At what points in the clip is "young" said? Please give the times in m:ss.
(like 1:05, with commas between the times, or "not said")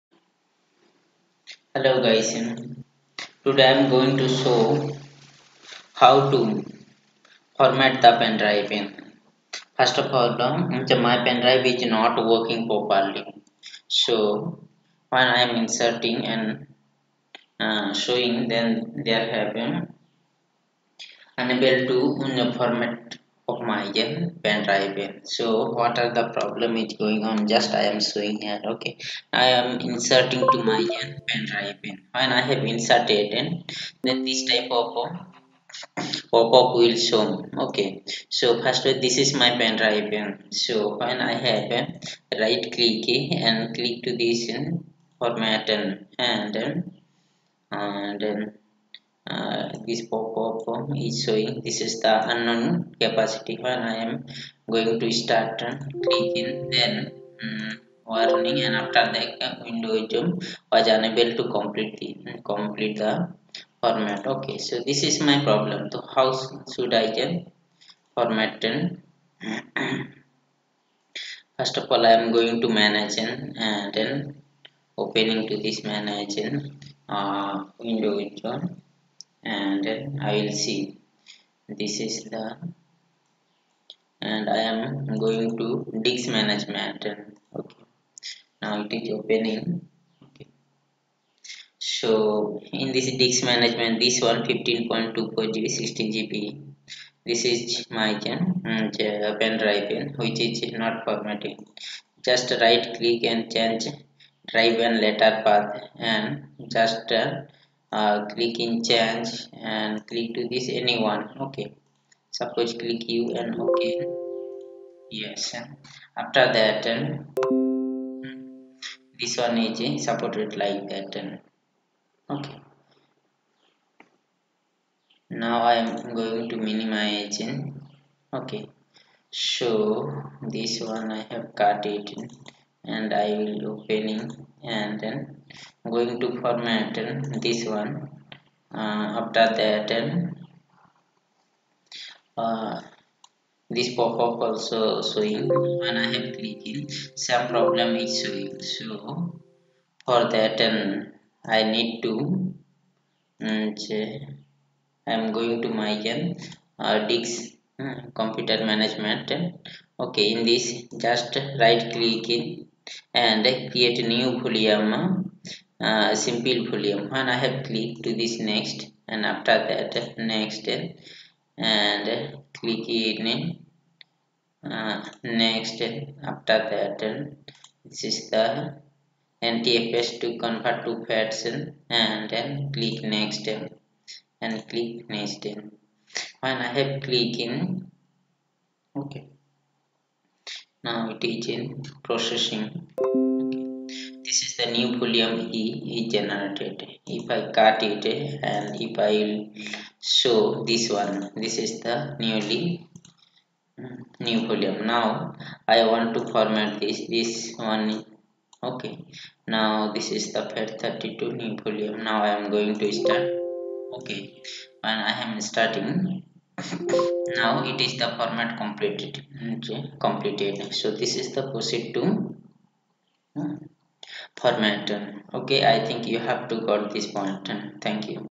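not said.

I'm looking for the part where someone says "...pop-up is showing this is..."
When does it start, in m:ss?
0:50.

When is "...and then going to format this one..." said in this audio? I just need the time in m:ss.
2:14.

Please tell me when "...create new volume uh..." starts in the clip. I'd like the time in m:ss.
2:43.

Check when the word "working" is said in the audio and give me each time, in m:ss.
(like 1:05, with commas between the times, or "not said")
0:12.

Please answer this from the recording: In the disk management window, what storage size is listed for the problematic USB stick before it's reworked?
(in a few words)
15.24 GB.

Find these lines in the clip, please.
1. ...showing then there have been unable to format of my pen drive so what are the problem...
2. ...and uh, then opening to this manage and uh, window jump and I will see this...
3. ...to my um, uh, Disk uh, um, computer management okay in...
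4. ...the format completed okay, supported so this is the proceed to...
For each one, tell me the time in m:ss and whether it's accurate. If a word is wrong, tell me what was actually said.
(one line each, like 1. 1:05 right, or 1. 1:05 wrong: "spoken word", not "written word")
1. 0:18 right
2. 1:13 right
3. 2:35 right
4. 3:38 wrong: "completed", not "supported".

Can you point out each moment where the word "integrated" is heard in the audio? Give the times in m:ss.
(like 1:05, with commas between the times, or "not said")
not said.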